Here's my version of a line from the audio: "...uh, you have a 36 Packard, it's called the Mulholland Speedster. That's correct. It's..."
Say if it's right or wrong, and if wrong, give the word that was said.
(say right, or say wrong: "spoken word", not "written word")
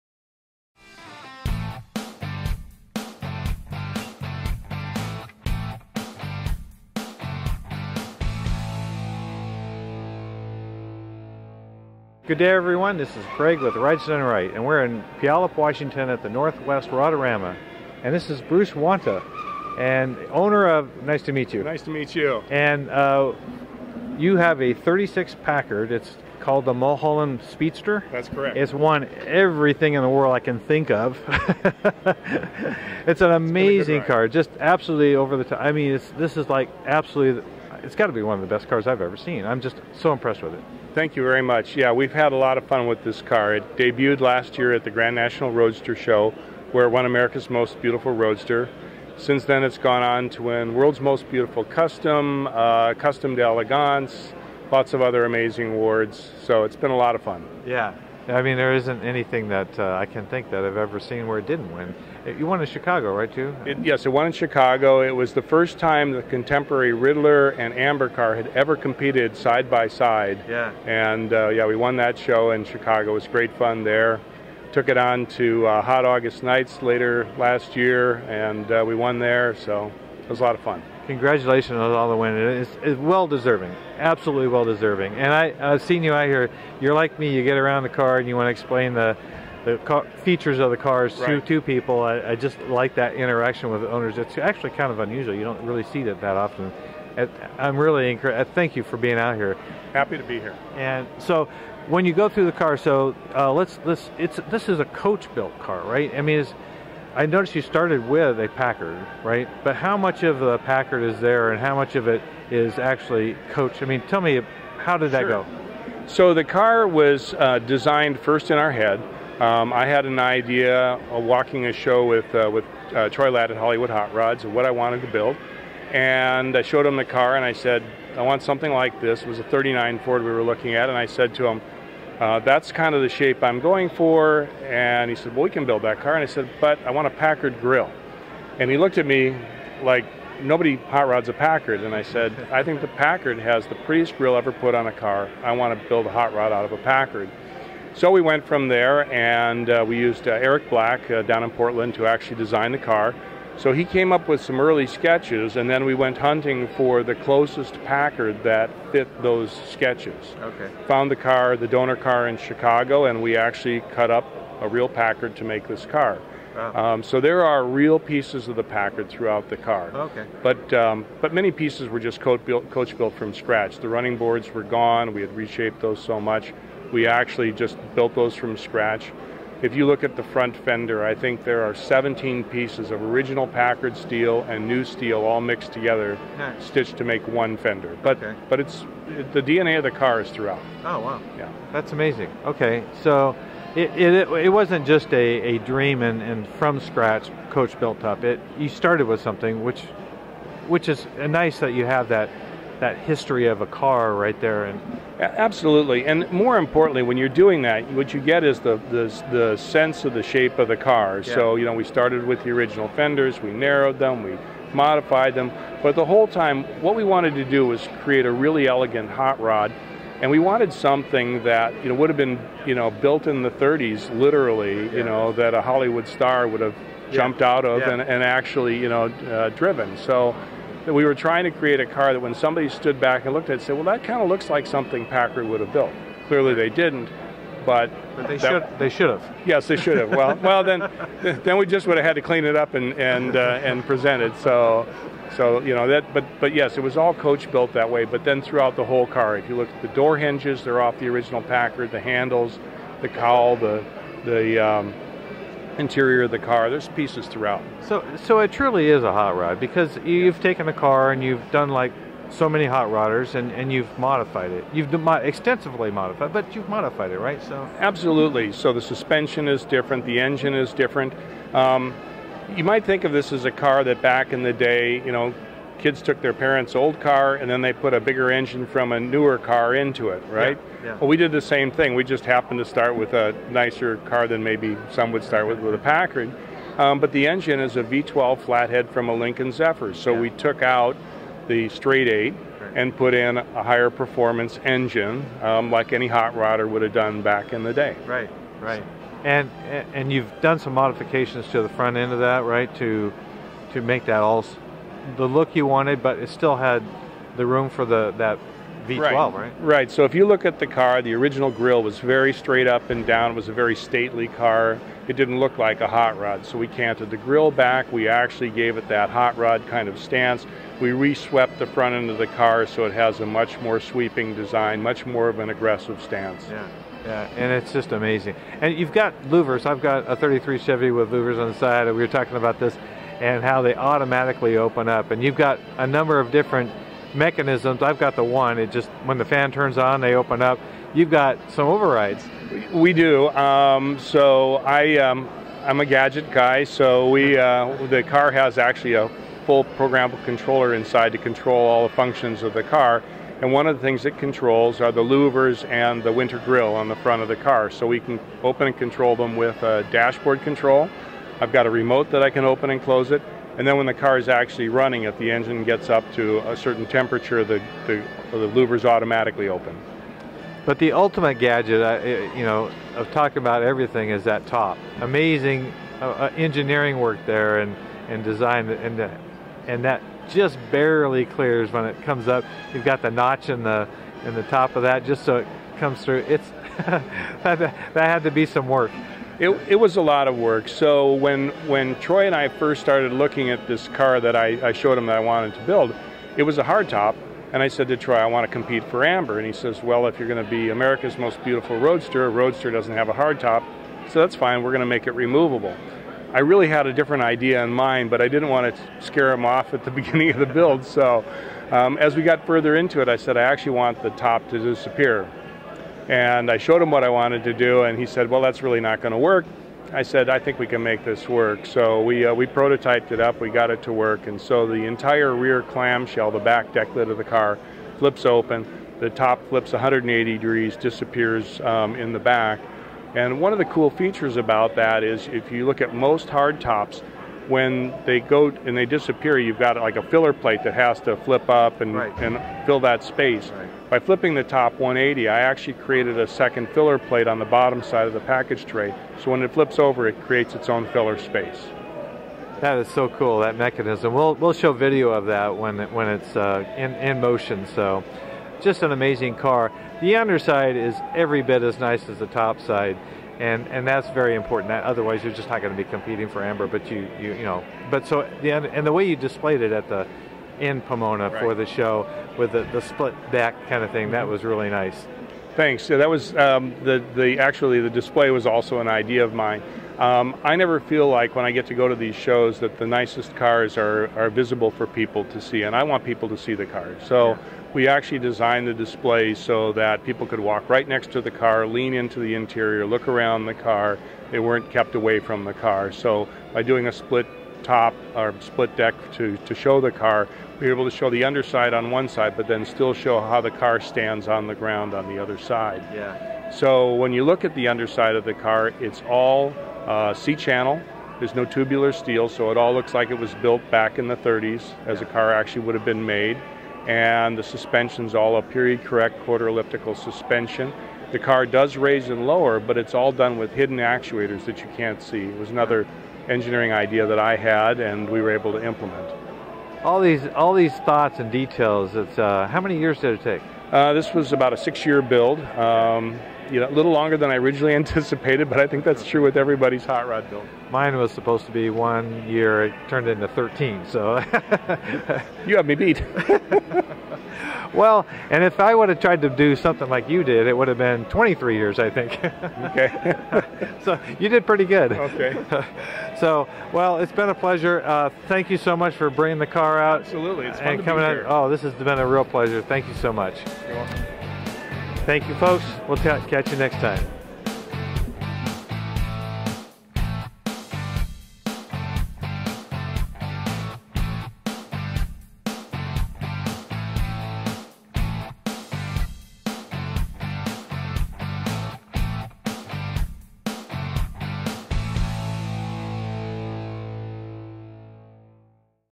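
right.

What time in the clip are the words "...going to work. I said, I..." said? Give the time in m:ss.
6:58.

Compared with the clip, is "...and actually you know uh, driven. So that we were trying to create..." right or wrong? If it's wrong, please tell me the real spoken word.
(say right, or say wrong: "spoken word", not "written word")
right.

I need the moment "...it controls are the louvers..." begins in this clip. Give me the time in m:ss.
5:54.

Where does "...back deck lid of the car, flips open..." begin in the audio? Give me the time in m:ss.
7:06.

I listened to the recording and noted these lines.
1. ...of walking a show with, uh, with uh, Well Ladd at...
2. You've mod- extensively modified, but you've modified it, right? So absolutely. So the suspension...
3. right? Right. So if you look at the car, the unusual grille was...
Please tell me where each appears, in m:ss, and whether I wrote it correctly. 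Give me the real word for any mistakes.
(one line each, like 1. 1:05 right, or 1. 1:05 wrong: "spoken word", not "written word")
1. 2:01 wrong: "Troy", not "Well"
2. 4:24 right
3. 5:09 wrong: "original", not "unusual".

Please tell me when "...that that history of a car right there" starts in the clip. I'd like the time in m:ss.
3:22.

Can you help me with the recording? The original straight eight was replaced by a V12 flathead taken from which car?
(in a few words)
Lincoln Zephyr.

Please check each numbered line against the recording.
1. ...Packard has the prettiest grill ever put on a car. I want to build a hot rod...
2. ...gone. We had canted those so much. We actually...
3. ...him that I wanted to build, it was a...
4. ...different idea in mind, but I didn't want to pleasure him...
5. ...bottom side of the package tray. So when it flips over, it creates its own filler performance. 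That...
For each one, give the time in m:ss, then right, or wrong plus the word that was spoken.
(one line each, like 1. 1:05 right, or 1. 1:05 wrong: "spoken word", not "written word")
1. 2:22 right
2. 2:54 wrong: "reshaped", not "canted"
3. 6:34 right
4. 6:46 wrong: "scare", not "pleasure"
5. 7:27 wrong: "space", not "performance".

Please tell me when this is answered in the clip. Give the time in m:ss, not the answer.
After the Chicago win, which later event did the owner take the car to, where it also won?
1:15.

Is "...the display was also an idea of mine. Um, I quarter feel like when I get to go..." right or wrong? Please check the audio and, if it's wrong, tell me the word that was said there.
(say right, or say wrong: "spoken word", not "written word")
wrong: "never", not "quarter".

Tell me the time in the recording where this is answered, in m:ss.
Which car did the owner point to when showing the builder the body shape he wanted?
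2:09.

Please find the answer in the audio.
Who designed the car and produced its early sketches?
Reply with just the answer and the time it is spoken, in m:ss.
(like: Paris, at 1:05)
Eric Black, at 2:30.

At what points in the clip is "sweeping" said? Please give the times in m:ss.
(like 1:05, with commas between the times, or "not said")
5:23.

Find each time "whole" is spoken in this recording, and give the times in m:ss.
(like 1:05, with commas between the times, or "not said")
3:36, 4:08.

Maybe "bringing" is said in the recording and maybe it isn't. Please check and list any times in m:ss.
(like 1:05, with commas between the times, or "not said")
9:19.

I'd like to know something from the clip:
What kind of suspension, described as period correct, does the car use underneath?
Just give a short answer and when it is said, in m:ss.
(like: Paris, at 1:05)
Quarter elliptical, at 8:39.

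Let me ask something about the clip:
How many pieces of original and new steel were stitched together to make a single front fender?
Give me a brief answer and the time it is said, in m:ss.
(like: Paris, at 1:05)
17, at 3:01.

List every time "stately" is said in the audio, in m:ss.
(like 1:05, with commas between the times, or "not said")
5:13.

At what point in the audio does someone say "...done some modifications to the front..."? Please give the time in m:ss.
5:00.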